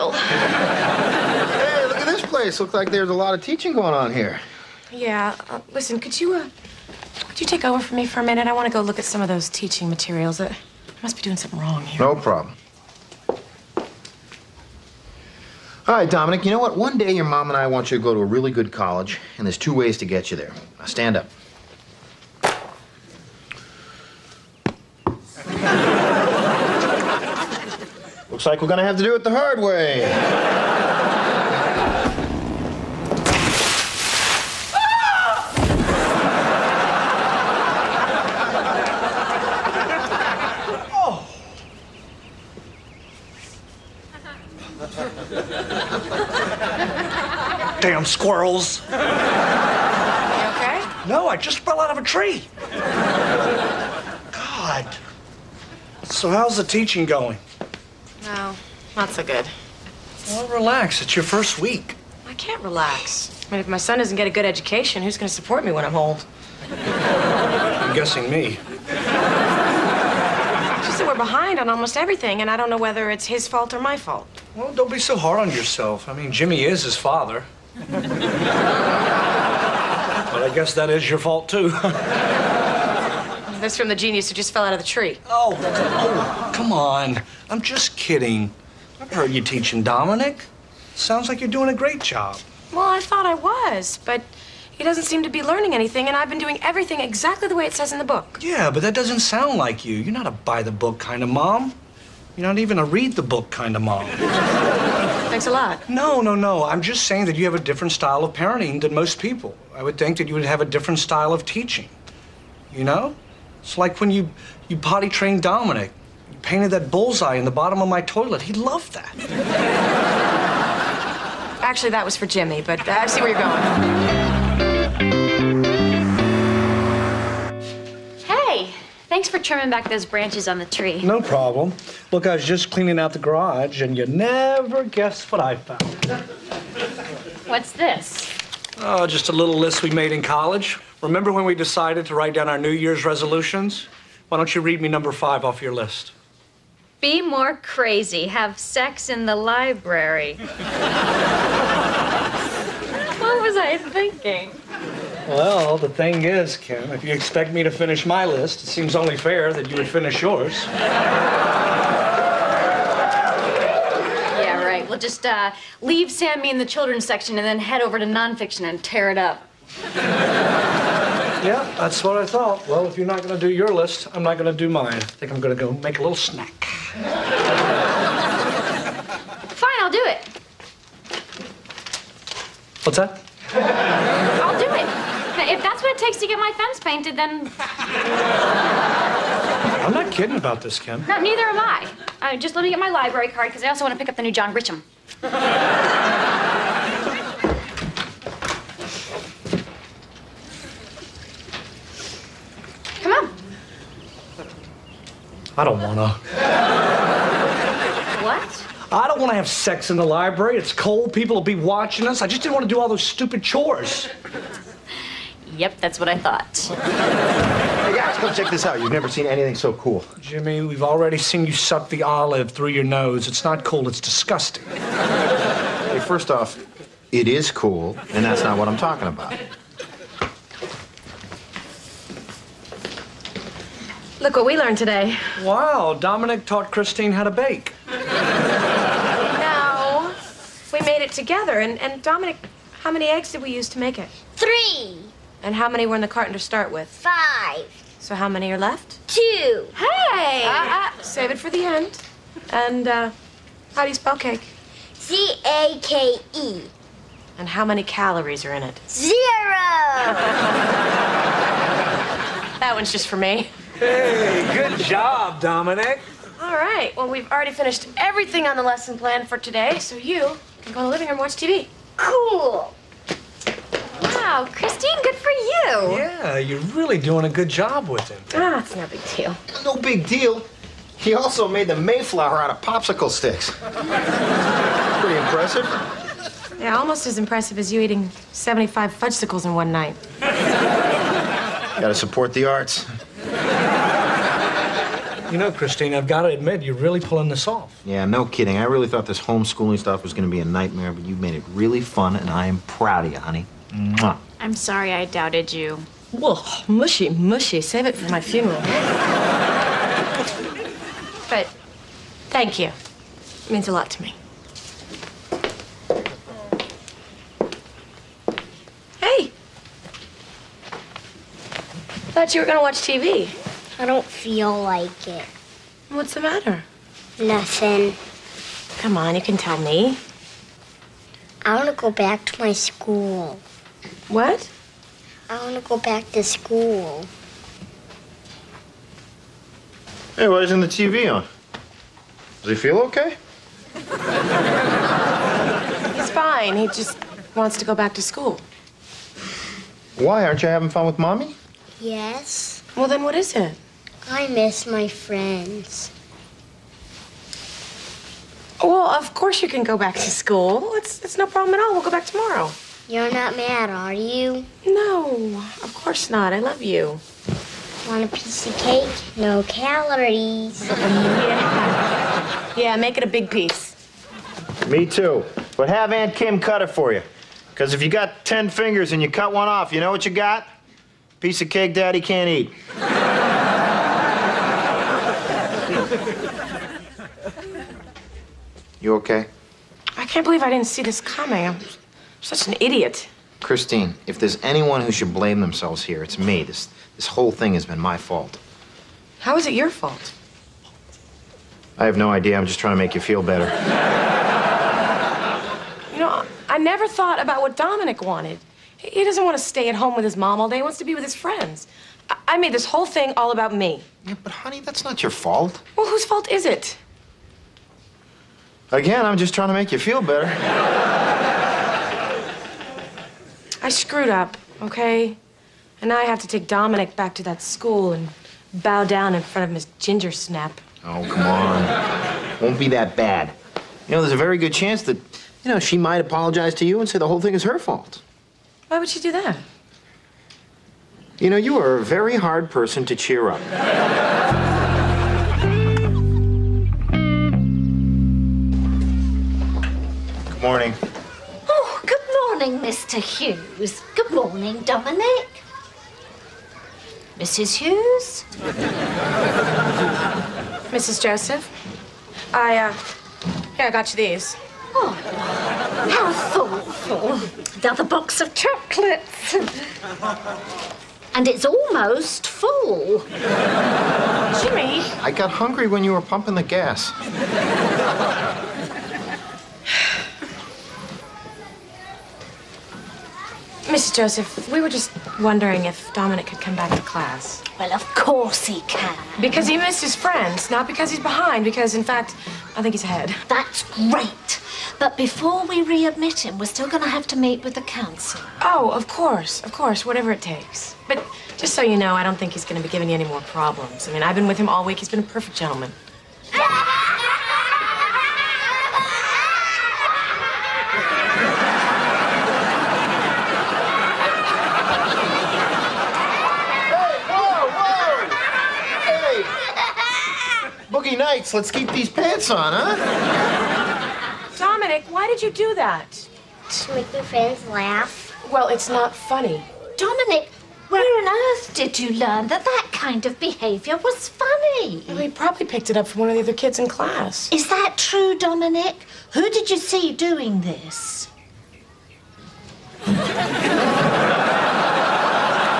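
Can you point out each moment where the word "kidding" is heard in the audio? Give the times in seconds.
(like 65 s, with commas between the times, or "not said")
87 s, 190 s, 298 s.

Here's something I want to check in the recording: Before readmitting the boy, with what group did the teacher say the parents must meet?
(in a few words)
The council.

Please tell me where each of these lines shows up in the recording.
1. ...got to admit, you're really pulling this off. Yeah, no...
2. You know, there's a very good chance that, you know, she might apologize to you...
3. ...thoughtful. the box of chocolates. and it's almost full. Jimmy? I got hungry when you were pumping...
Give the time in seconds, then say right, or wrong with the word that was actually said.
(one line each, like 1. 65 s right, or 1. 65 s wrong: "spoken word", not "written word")
1. 296 s right
2. 433 s right
3. 466 s right.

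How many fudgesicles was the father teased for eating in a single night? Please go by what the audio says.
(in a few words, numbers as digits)
75.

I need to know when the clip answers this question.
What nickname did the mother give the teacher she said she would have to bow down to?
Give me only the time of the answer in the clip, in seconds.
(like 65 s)
429 s.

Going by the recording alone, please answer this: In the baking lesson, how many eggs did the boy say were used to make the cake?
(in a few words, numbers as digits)
3.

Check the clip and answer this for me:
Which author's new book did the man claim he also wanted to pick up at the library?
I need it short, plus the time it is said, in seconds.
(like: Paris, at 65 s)
John Grisham, at 194 s.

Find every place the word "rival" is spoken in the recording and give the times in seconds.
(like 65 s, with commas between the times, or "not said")
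not said.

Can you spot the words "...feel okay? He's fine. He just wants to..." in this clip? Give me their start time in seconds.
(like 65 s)
342 s.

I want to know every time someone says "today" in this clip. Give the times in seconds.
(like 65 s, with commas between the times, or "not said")
234 s, 269 s.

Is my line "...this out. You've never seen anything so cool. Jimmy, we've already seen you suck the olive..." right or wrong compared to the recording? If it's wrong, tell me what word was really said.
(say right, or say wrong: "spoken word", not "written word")
right.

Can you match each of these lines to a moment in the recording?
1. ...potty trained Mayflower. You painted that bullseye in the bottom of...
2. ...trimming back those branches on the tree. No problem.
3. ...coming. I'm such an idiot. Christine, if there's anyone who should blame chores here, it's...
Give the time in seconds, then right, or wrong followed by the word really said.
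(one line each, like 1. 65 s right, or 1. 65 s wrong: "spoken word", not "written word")
1. 114 s wrong: "Dominic", not "Mayflower"
2. 129 s right
3. 390 s wrong: "themselves", not "chores".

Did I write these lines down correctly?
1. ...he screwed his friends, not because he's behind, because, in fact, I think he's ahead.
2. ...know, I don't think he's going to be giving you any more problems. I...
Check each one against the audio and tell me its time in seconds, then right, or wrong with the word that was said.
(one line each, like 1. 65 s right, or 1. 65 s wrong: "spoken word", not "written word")
1. 489 s wrong: "missed", not "screwed"
2. 501 s right.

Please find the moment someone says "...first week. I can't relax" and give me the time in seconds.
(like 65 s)
61 s.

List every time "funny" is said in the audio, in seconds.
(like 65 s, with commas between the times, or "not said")
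528 s, 534 s.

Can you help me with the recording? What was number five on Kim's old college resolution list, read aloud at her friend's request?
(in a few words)
Be more crazy.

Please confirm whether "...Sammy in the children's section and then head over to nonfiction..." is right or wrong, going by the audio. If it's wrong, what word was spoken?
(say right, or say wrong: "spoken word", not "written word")
right.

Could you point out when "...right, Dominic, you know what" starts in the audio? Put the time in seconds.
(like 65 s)
15 s.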